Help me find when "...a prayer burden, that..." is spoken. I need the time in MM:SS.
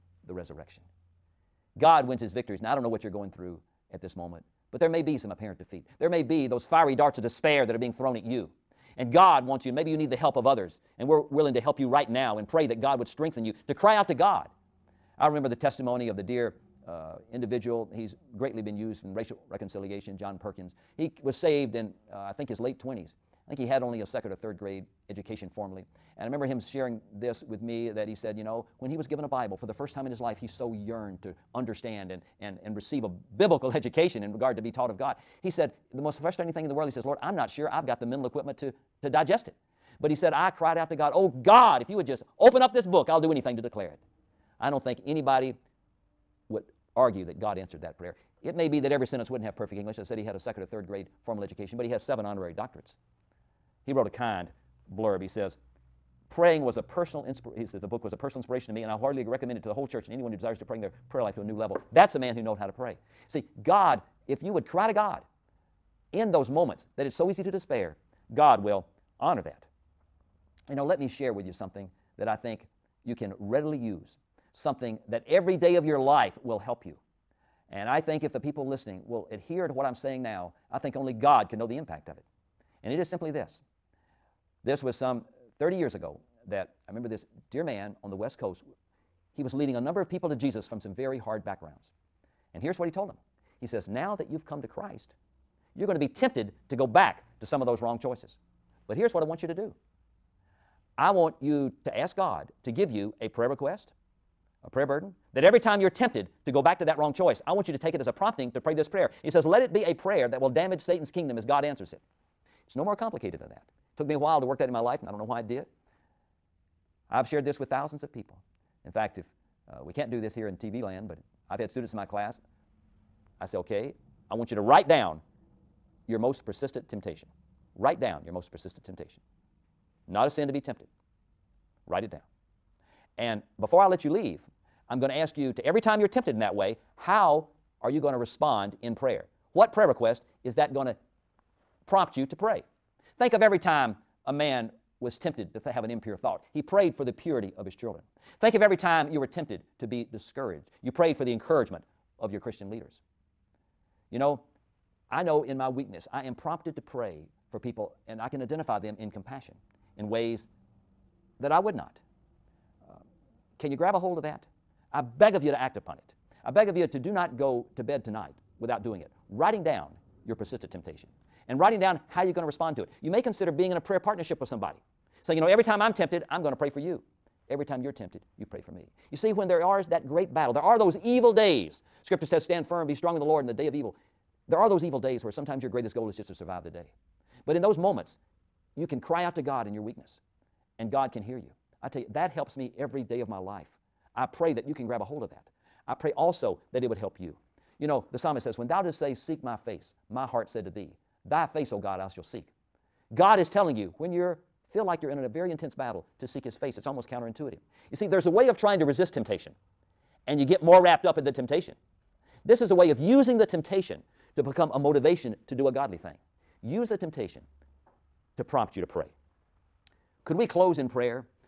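01:44.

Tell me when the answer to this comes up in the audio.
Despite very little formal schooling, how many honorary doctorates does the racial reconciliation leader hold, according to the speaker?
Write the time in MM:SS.
00:52.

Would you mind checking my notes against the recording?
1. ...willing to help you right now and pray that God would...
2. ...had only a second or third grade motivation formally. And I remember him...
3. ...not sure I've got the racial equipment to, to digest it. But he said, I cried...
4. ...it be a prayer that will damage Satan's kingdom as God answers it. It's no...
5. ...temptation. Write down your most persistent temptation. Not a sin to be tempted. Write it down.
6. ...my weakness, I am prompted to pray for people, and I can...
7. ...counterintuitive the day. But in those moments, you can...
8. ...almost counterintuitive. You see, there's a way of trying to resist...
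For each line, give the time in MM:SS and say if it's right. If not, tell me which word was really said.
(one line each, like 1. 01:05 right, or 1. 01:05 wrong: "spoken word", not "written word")
1. 00:11 right
2. 00:23 wrong: "education", not "motivation"
3. 00:37 wrong: "mental", not "racial"
4. 01:49 right
5. 02:06 right
6. 02:35 right
7. 03:06 wrong: "survive", not "counterintuitive"
8. 03:26 right.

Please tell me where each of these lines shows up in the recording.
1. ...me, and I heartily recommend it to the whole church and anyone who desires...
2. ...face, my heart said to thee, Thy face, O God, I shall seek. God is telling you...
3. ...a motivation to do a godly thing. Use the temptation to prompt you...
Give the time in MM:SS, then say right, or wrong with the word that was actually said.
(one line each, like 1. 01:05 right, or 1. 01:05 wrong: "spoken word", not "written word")
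1. 00:58 right
2. 03:19 right
3. 03:34 right.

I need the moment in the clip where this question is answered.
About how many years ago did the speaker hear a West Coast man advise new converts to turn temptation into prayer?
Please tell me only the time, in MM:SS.
01:24.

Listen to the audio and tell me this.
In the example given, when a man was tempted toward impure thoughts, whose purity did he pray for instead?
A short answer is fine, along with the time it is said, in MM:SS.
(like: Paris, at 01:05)
His children's, at 02:27.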